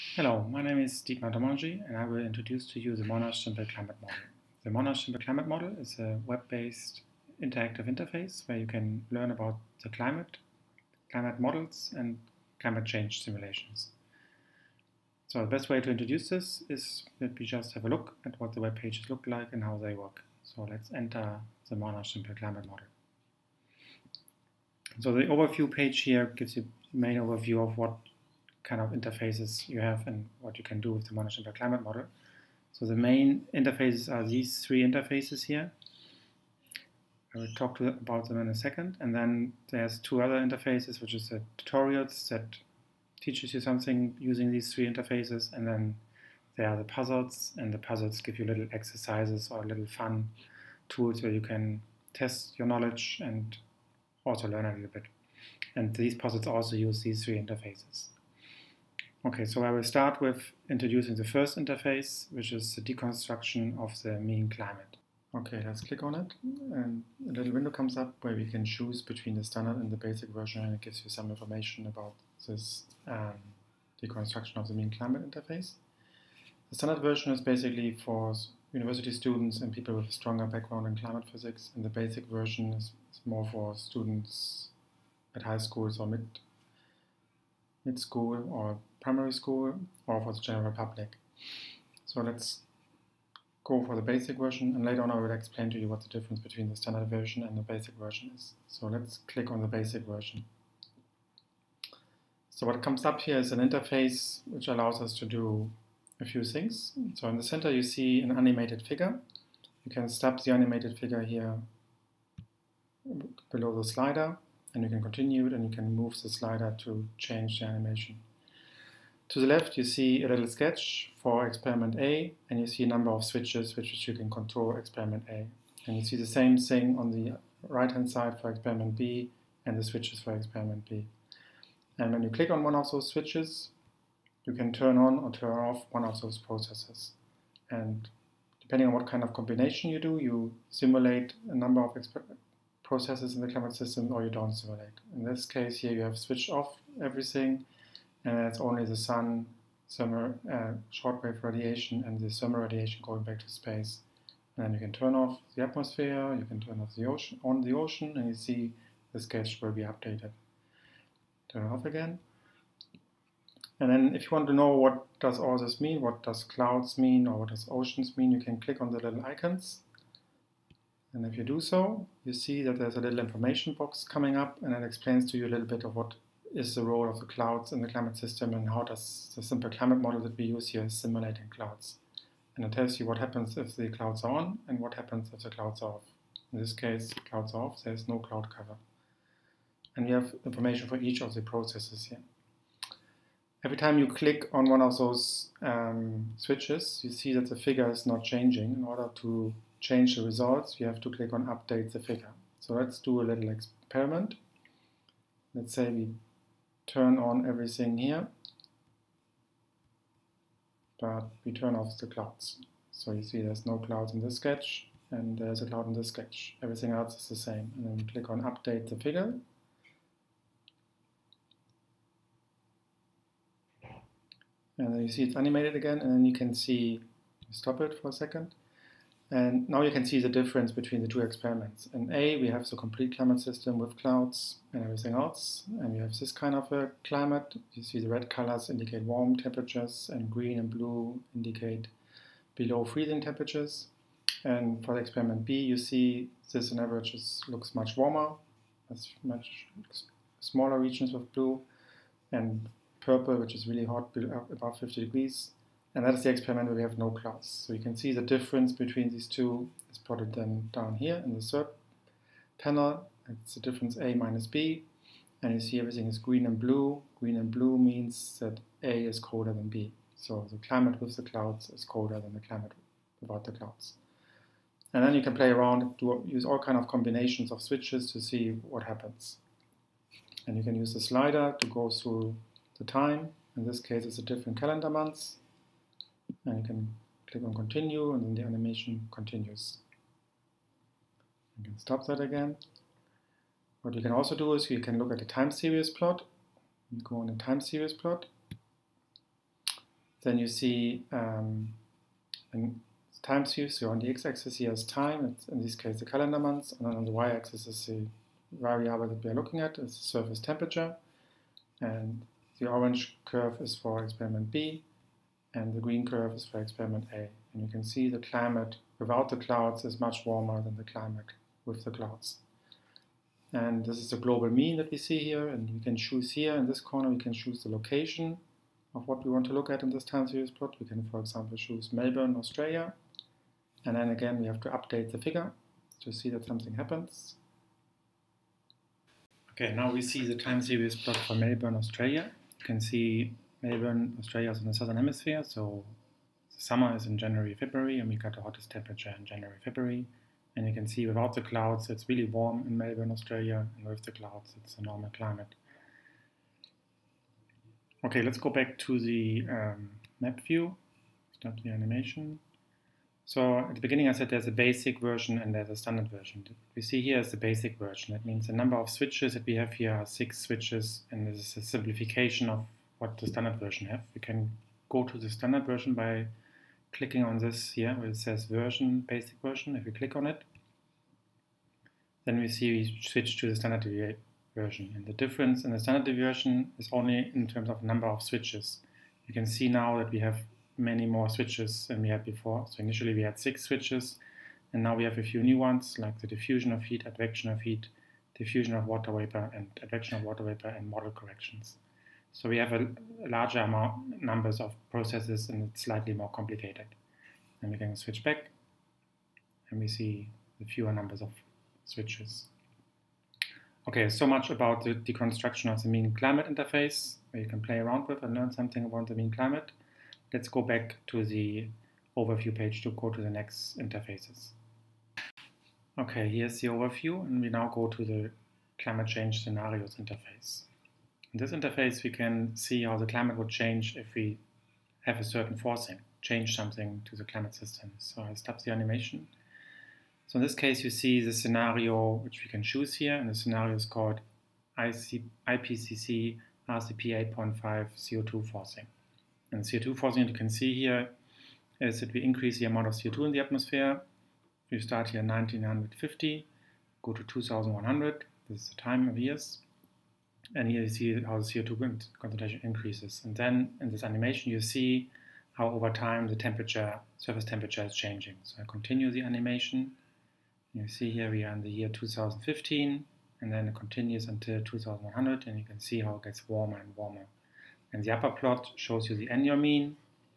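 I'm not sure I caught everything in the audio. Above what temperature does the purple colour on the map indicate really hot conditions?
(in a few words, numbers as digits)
50 degrees.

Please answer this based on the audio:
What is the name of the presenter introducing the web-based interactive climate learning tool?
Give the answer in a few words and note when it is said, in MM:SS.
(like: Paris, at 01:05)
Dietmar Dommenget, at 00:01.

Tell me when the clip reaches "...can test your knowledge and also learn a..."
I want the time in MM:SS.
00:51.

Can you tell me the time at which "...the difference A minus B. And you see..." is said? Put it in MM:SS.
04:23.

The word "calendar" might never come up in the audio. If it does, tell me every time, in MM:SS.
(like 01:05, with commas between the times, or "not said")
04:44, 05:06.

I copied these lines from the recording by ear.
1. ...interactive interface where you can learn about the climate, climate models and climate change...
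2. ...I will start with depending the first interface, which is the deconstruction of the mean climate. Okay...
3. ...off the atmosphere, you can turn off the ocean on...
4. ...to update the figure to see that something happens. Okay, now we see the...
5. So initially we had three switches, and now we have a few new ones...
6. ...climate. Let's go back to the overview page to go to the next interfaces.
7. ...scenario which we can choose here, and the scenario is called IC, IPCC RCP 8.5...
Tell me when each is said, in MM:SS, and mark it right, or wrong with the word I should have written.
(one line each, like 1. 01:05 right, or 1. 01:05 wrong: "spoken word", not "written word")
1. 00:07 right
2. 00:59 wrong: "introducing", not "depending"
3. 02:35 right
4. 05:34 right
5. 06:32 wrong: "six", not "three"
6. 06:59 right
7. 07:21 right.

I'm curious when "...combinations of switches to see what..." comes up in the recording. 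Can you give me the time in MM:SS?
04:36.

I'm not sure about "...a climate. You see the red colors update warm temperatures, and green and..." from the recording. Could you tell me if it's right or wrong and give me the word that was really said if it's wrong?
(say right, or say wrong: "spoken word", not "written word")
wrong: "indicate", not "update".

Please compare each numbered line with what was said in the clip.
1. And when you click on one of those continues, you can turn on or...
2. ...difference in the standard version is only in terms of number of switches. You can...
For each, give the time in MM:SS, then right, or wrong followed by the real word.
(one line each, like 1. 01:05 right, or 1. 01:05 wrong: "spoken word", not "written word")
1. 02:11 wrong: "switches", not "continues"
2. 06:25 right.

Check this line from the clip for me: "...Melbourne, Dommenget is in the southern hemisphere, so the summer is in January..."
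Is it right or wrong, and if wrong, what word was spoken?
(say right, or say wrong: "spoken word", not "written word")
wrong: "Australia", not "Dommenget".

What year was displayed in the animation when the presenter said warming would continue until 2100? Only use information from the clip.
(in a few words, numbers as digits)
2015.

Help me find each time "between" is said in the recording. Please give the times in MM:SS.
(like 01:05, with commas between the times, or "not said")
01:09, 01:36, 03:50, 04:18.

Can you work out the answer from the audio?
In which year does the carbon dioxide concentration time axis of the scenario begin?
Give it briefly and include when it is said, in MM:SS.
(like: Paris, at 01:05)
1950, at 07:35.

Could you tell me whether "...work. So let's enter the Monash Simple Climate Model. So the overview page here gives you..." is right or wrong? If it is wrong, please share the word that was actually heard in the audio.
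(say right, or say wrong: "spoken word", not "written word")
right.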